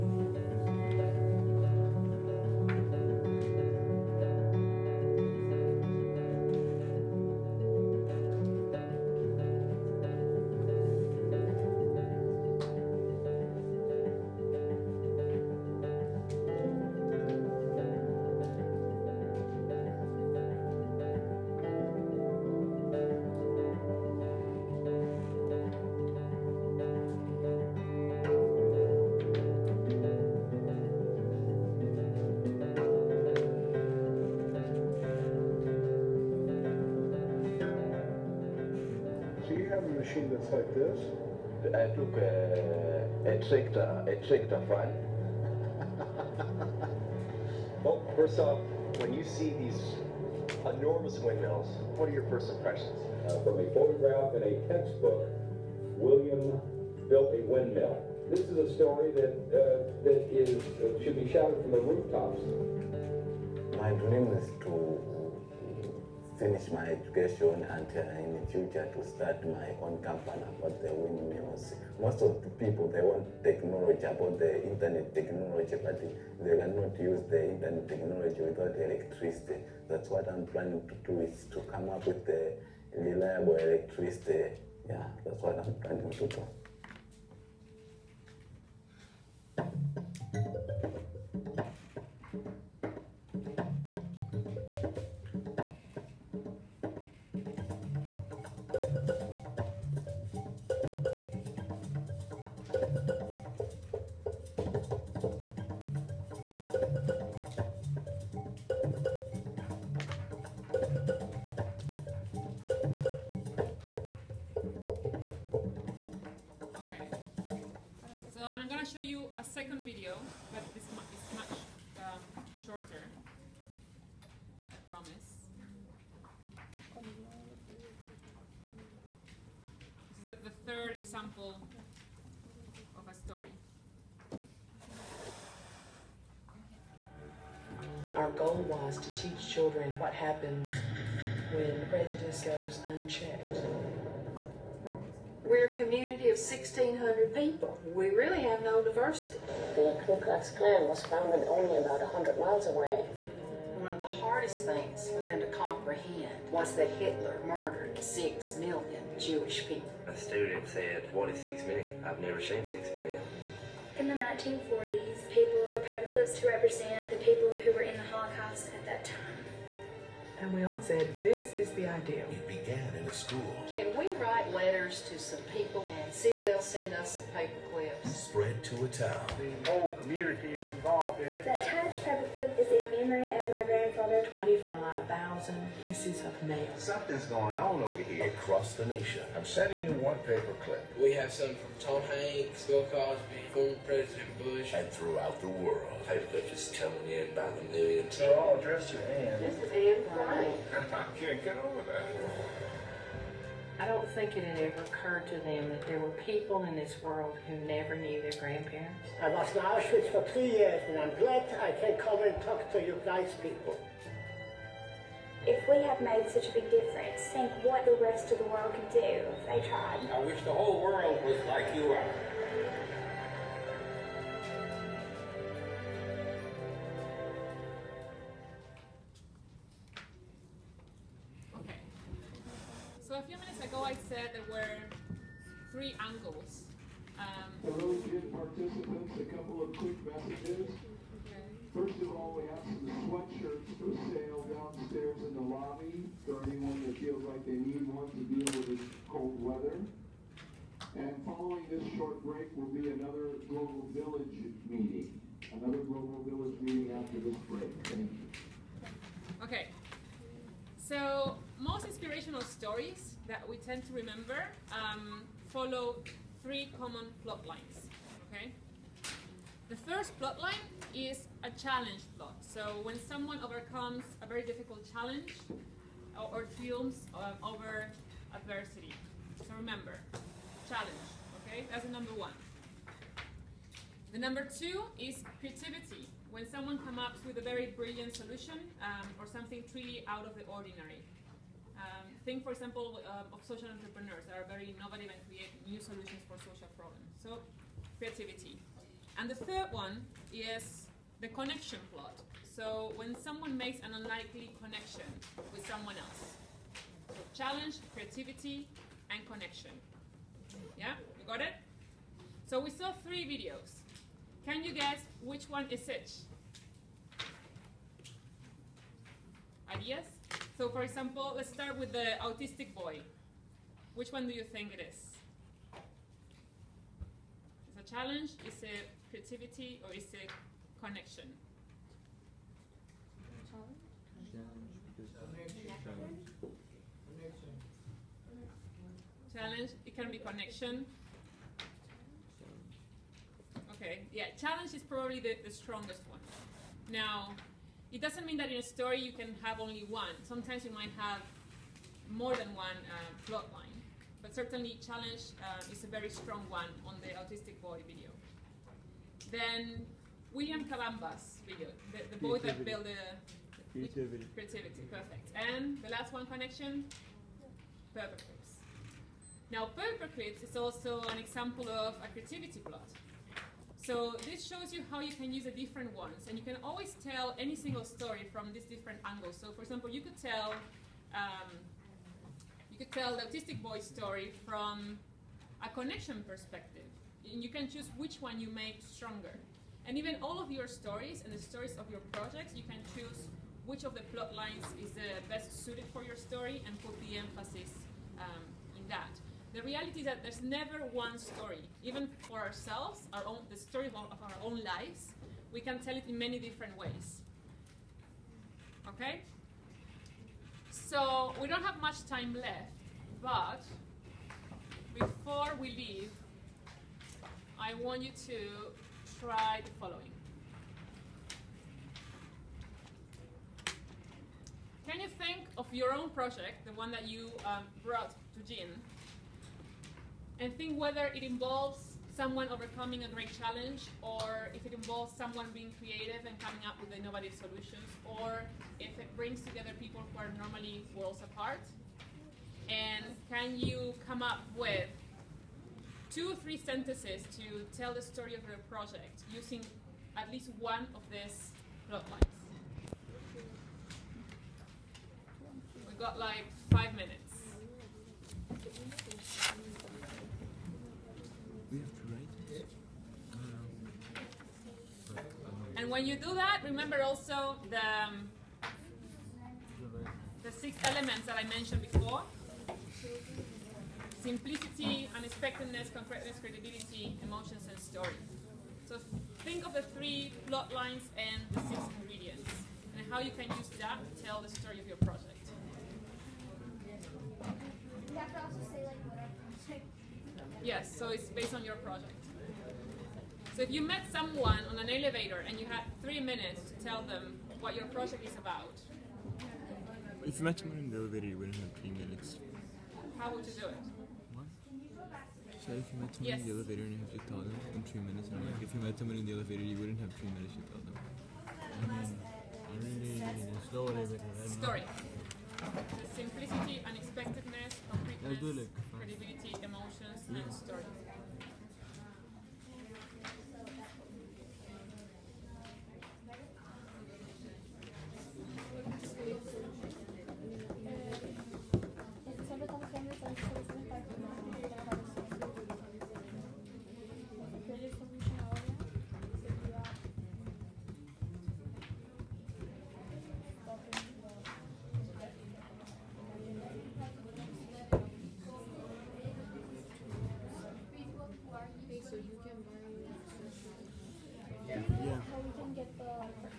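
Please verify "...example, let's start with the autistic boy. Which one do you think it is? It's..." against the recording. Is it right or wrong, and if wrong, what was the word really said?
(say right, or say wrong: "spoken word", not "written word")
right.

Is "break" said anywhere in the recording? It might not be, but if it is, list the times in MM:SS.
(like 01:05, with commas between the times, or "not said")
04:12, 04:17.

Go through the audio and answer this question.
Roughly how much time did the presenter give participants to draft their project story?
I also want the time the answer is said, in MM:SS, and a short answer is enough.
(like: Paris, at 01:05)
5 minutes, at 07:36.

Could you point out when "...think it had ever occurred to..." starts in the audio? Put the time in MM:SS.
03:24.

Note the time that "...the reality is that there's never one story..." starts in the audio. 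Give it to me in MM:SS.
06:39.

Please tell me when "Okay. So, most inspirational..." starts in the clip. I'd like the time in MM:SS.
04:19.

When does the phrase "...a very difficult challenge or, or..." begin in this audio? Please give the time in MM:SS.
04:34.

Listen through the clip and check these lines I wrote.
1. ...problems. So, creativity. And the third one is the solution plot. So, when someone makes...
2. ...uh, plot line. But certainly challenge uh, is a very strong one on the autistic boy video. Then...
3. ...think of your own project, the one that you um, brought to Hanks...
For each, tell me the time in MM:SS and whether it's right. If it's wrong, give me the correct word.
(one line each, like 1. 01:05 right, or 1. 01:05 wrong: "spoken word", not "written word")
1. 04:56 wrong: "connection", not "solution"
2. 05:52 right
3. 07:05 wrong: "Jean", not "Hanks".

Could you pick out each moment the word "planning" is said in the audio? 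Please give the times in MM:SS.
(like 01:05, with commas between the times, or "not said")
01:20, 01:25.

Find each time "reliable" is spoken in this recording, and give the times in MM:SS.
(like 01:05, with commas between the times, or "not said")
01:22.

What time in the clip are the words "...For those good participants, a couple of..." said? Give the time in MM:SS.
03:57.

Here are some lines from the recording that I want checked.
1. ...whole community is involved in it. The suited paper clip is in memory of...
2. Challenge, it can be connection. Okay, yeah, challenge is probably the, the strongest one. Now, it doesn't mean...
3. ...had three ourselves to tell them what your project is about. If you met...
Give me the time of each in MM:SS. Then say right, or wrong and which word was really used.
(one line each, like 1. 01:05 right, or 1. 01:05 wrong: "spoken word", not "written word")
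1. 02:59 wrong: "attached", not "suited"
2. 05:39 right
3. 08:15 wrong: "minutes", not "ourselves".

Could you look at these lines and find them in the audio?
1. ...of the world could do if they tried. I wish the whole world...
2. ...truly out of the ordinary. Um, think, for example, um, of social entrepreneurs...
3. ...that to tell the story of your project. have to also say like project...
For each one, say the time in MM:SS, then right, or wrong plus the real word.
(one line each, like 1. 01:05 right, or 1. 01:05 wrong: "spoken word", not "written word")
1. 03:38 right
2. 04:49 right
3. 08:03 right.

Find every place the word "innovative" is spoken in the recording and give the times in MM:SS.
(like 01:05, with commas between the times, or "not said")
04:54, 07:16.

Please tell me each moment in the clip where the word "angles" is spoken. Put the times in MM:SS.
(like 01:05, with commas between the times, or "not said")
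03:55, 06:19.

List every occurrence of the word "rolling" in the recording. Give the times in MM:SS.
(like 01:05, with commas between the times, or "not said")
not said.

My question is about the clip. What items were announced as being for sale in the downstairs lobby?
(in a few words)
Sweatshirts.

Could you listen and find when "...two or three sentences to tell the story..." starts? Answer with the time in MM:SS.
07:26.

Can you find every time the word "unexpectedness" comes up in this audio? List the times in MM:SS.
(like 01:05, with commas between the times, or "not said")
07:55, 08:36.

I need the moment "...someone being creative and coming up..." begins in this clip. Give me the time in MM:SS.
07:15.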